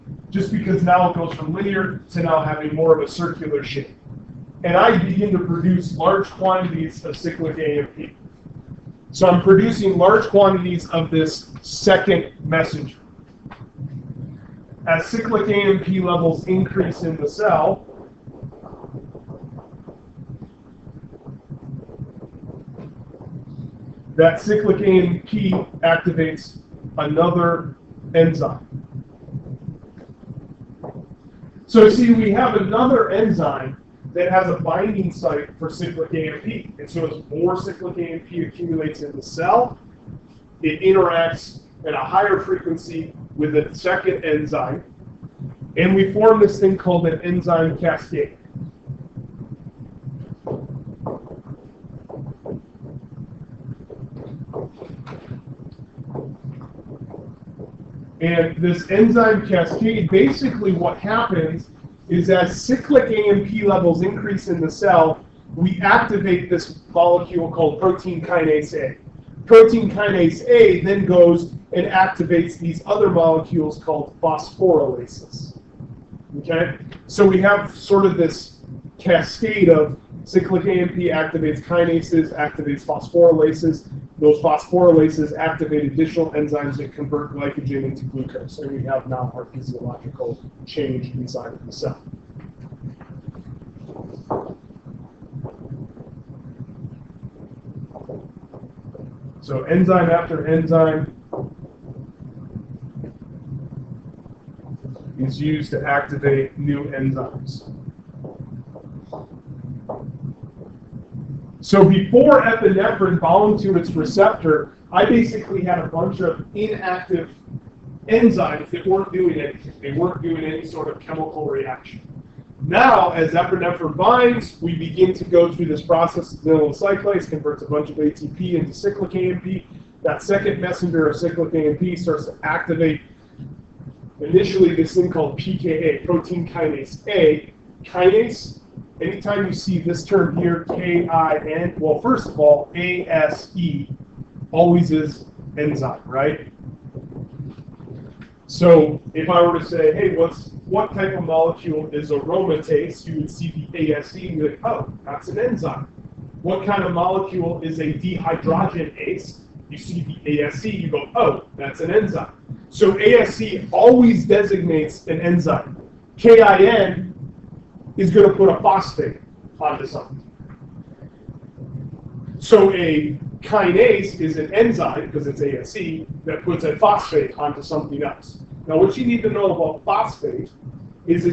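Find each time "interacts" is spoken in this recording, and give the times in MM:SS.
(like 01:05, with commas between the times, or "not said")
00:40.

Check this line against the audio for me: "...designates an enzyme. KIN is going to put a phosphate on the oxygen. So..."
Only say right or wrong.
right.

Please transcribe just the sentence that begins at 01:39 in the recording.
So enzyme after enzyme is used to activate new enzymes.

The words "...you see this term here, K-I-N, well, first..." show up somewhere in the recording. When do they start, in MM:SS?
02:19.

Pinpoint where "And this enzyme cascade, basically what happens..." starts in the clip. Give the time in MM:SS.
00:58.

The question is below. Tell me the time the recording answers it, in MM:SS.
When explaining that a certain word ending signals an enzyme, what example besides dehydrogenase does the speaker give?
02:32.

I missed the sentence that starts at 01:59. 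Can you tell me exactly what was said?
They weren't doing any sort of chemical reaction.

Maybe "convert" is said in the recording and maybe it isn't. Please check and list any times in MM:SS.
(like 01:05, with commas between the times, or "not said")
01:26, 02:07.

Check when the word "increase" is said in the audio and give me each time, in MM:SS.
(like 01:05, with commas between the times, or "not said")
00:16, 01:04.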